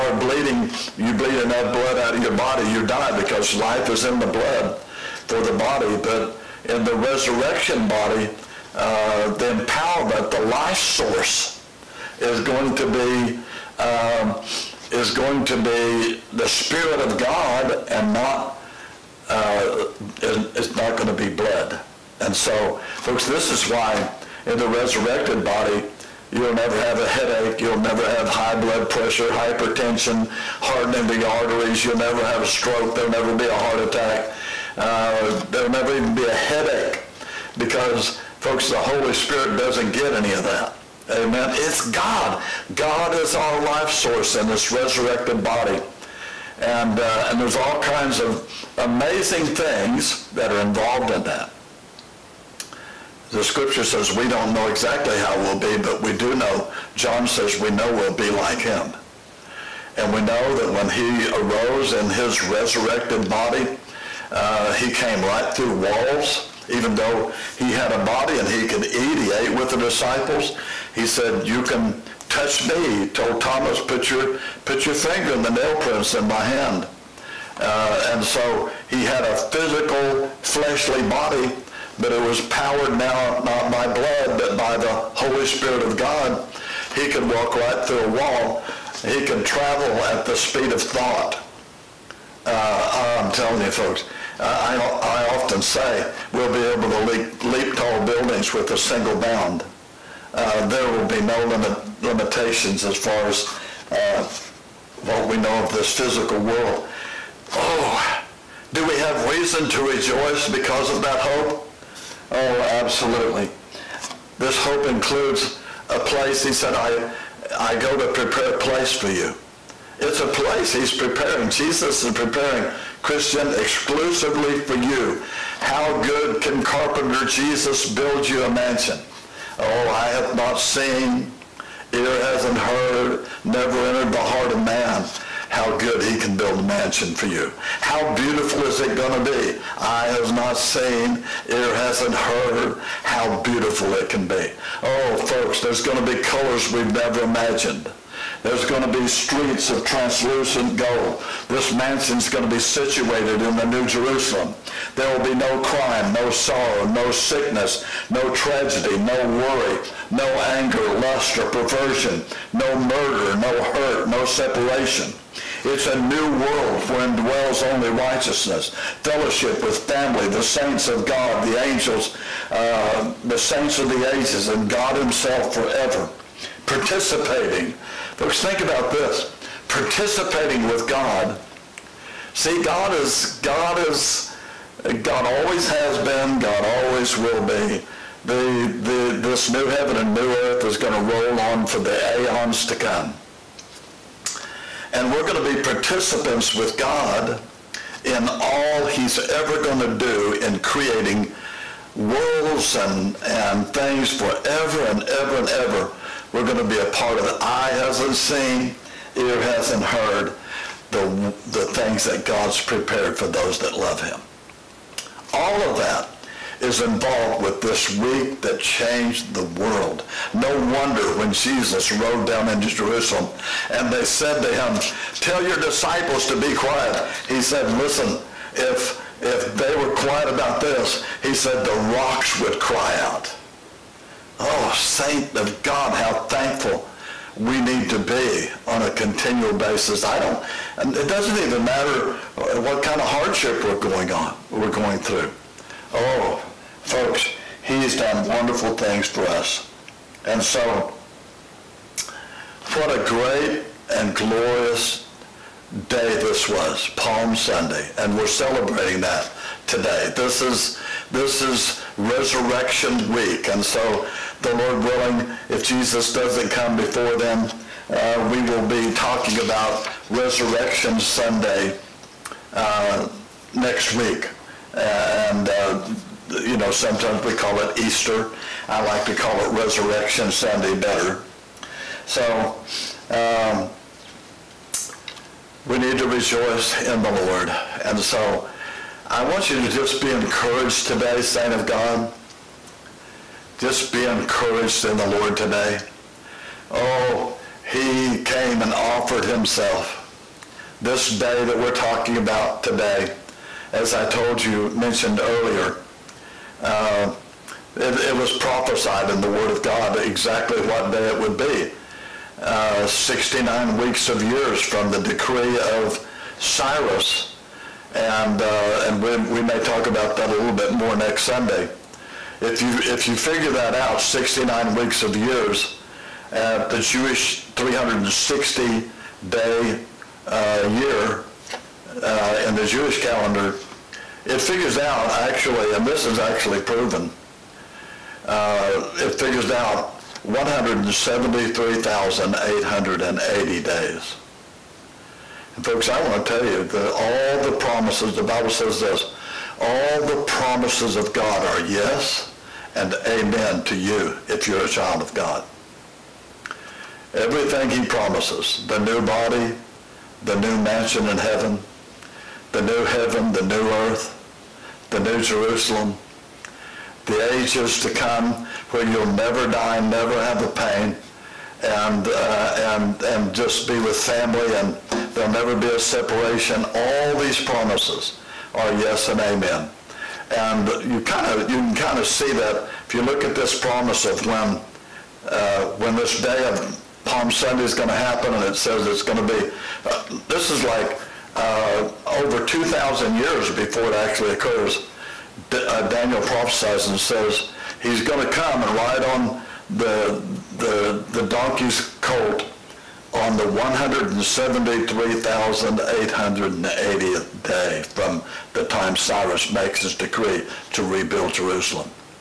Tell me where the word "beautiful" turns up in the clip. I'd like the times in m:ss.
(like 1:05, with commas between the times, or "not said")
2:18, 2:23.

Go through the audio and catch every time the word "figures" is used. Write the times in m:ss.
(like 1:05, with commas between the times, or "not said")
5:23, 5:34, 5:39.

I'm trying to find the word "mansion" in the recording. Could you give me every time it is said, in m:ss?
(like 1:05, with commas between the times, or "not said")
2:08, 2:16, 2:31, 6:00.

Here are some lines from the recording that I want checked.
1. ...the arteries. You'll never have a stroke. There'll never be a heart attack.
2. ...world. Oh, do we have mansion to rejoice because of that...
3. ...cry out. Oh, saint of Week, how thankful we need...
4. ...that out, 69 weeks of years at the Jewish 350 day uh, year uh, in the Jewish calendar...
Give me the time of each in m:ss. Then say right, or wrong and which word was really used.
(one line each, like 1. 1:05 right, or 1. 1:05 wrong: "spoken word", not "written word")
1. 0:31 right
2. 1:46 wrong: "reason", not "mansion"
3. 3:52 wrong: "God", not "Week"
4. 5:23 wrong: "360", not "350".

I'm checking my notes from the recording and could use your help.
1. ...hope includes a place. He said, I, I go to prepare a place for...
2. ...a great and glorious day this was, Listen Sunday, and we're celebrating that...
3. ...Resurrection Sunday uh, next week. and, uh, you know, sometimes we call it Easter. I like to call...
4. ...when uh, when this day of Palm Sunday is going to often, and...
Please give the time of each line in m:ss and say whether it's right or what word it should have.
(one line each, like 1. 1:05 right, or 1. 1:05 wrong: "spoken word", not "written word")
1. 1:54 right
2. 4:12 wrong: "Palm", not "Listen"
3. 4:30 right
4. 6:24 wrong: "happen", not "often".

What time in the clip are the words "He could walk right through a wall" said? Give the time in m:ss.
1:26.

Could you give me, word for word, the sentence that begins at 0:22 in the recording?
And so, folks, this is why in the resurrected body, You'll never have a headache.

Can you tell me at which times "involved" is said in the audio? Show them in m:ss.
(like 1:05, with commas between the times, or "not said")
0:50, 3:36.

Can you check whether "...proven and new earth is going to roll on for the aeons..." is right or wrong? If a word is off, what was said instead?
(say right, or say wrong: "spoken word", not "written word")
wrong: "heaven", not "proven".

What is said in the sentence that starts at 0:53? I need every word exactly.
The scripture says we don't know exactly how we'll be, but we do know.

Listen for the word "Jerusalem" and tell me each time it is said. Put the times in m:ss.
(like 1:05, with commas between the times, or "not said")
2:33, 3:42, 6:05, 6:51.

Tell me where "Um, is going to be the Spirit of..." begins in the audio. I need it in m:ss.
0:13.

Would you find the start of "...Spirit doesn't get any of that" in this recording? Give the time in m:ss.
0:39.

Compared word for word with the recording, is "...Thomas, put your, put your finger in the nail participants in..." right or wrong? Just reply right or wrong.
wrong.